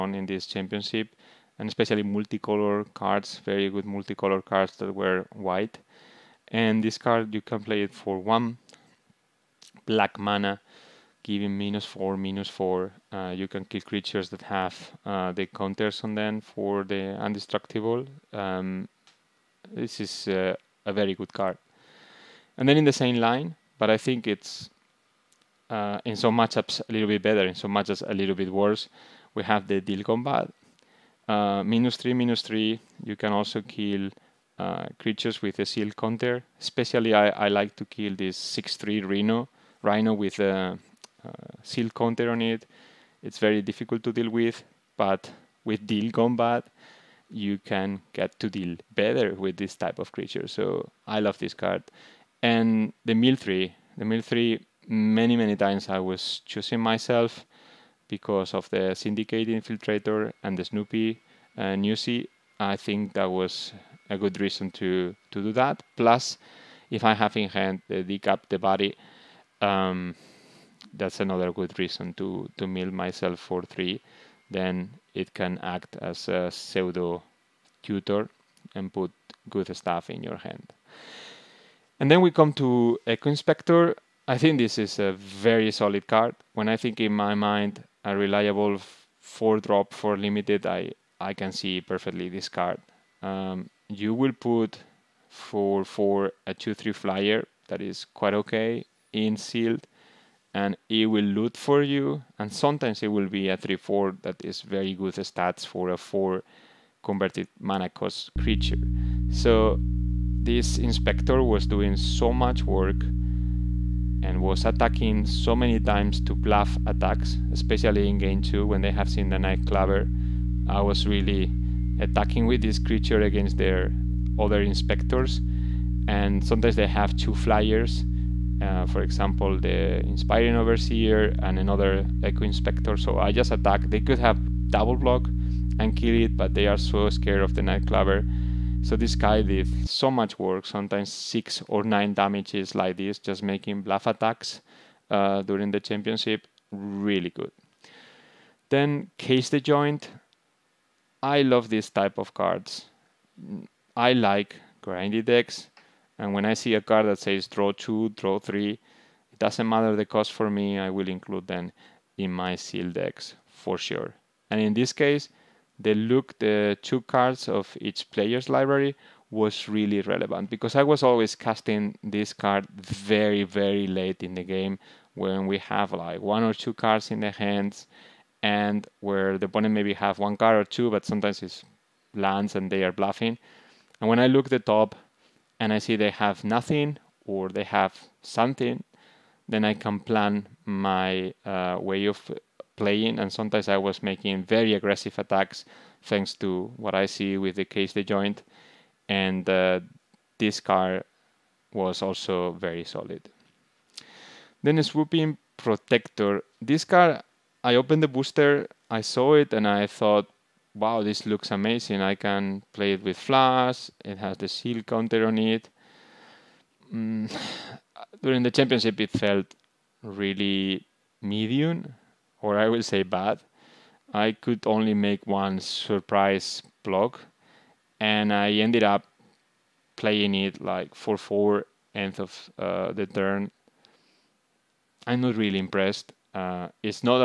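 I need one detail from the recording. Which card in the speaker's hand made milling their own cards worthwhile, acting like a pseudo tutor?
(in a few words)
Dig Up the Body.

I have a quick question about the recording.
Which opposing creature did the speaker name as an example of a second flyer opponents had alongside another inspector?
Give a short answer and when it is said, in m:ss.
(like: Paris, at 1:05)
Inspiring Overseer, at 2:10.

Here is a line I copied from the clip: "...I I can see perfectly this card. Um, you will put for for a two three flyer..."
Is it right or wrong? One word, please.
right.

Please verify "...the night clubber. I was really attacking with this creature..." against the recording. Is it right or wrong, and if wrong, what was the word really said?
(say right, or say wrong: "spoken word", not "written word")
right.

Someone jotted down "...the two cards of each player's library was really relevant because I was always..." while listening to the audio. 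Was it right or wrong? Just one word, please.
right.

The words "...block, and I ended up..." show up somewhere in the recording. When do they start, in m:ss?
3:46.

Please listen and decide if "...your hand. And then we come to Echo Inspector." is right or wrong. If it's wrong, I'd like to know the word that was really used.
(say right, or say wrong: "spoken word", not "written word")
right.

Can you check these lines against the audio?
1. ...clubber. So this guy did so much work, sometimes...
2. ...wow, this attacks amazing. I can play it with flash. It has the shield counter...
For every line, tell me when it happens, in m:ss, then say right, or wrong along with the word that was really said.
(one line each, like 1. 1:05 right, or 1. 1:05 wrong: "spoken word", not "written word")
1. 2:17 right
2. 3:30 wrong: "looks", not "attacks".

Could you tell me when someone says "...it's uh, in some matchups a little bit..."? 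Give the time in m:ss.
0:24.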